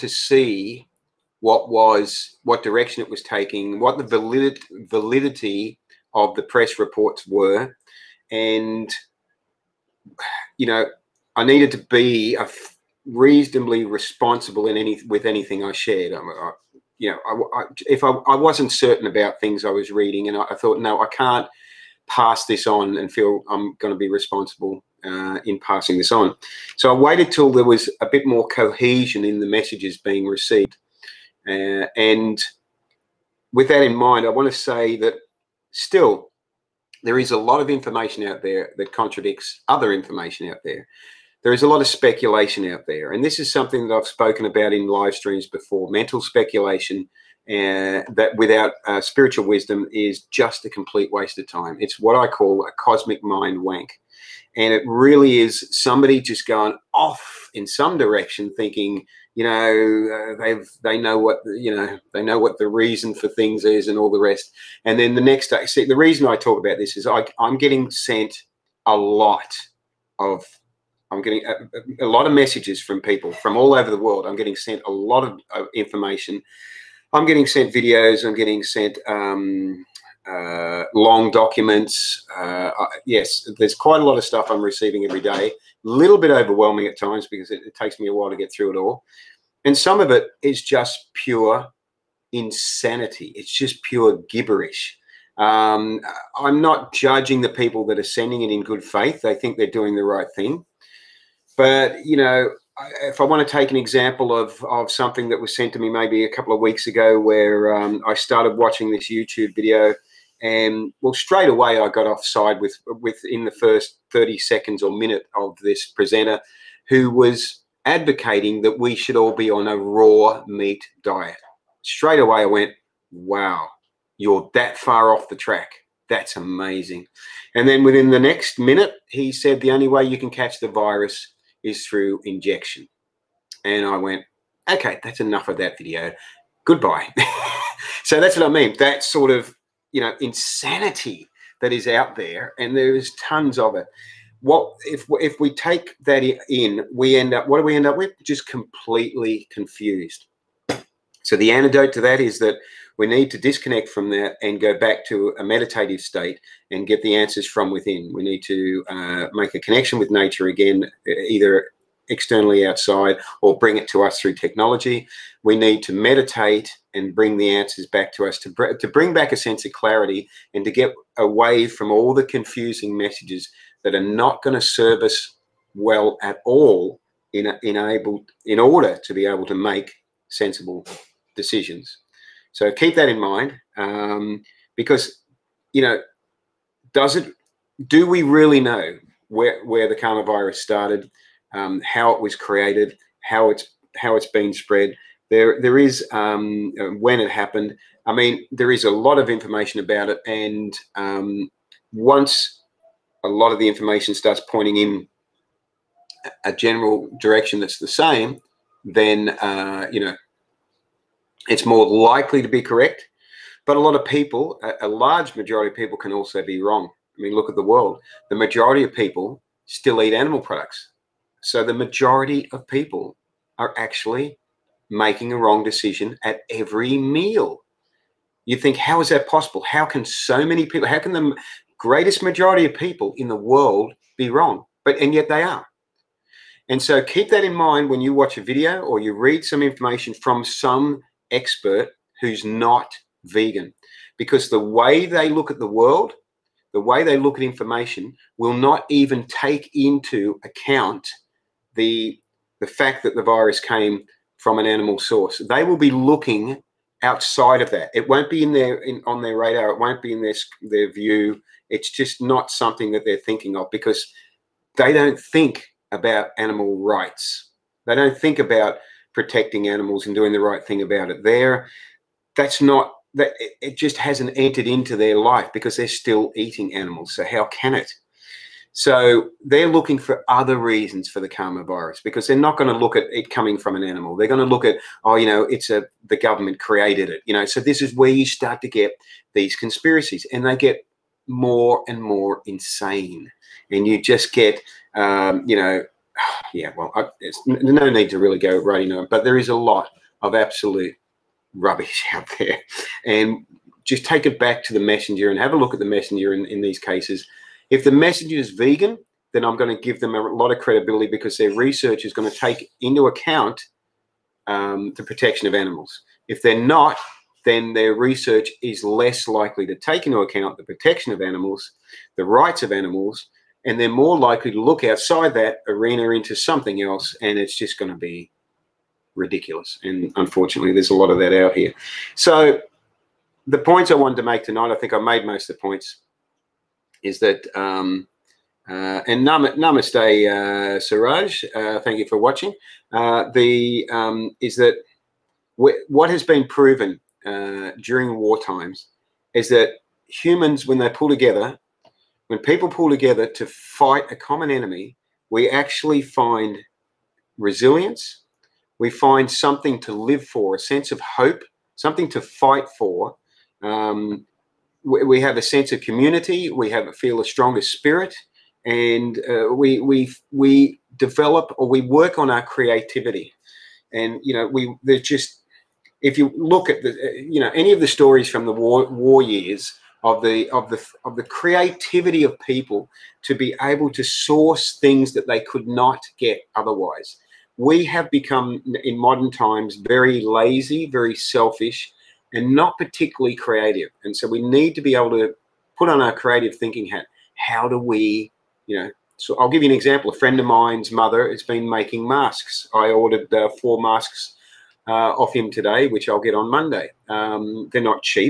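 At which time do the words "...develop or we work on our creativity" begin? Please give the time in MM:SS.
06:10.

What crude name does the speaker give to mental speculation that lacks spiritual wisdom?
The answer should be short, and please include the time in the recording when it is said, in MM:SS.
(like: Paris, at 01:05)
cosmic mind wank, at 00:52.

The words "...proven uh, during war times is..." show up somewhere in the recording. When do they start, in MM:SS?
05:46.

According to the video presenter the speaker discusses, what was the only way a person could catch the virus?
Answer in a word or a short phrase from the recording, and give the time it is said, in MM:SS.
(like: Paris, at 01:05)
through injection, at 02:11.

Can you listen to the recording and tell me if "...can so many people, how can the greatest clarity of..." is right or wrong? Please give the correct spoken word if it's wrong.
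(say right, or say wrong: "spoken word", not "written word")
wrong: "majority", not "clarity".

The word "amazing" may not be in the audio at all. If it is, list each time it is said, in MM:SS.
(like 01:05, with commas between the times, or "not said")
02:06.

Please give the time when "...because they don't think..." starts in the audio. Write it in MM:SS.
04:23.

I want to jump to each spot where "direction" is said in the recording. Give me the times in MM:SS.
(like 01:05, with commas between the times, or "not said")
00:02, 00:57, 03:27.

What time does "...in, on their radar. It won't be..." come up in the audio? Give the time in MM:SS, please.
04:18.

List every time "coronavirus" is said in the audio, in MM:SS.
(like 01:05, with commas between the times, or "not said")
03:09.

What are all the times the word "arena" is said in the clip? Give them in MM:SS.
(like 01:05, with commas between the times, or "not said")
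05:25.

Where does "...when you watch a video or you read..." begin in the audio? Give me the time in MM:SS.
03:57.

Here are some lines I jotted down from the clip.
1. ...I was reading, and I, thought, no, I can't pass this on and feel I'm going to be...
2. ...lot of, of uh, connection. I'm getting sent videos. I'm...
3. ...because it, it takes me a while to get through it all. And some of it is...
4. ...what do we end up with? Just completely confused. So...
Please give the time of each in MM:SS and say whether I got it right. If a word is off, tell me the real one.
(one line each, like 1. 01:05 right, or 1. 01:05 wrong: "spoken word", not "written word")
1. 00:19 right
2. 01:14 wrong: "information", not "connection"
3. 01:27 right
4. 02:27 right.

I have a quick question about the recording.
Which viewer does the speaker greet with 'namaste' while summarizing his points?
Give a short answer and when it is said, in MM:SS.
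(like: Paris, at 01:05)
Siraj, at 05:40.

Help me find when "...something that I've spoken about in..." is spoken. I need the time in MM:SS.
00:43.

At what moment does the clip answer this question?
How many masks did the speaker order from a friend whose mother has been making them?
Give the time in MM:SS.
06:43.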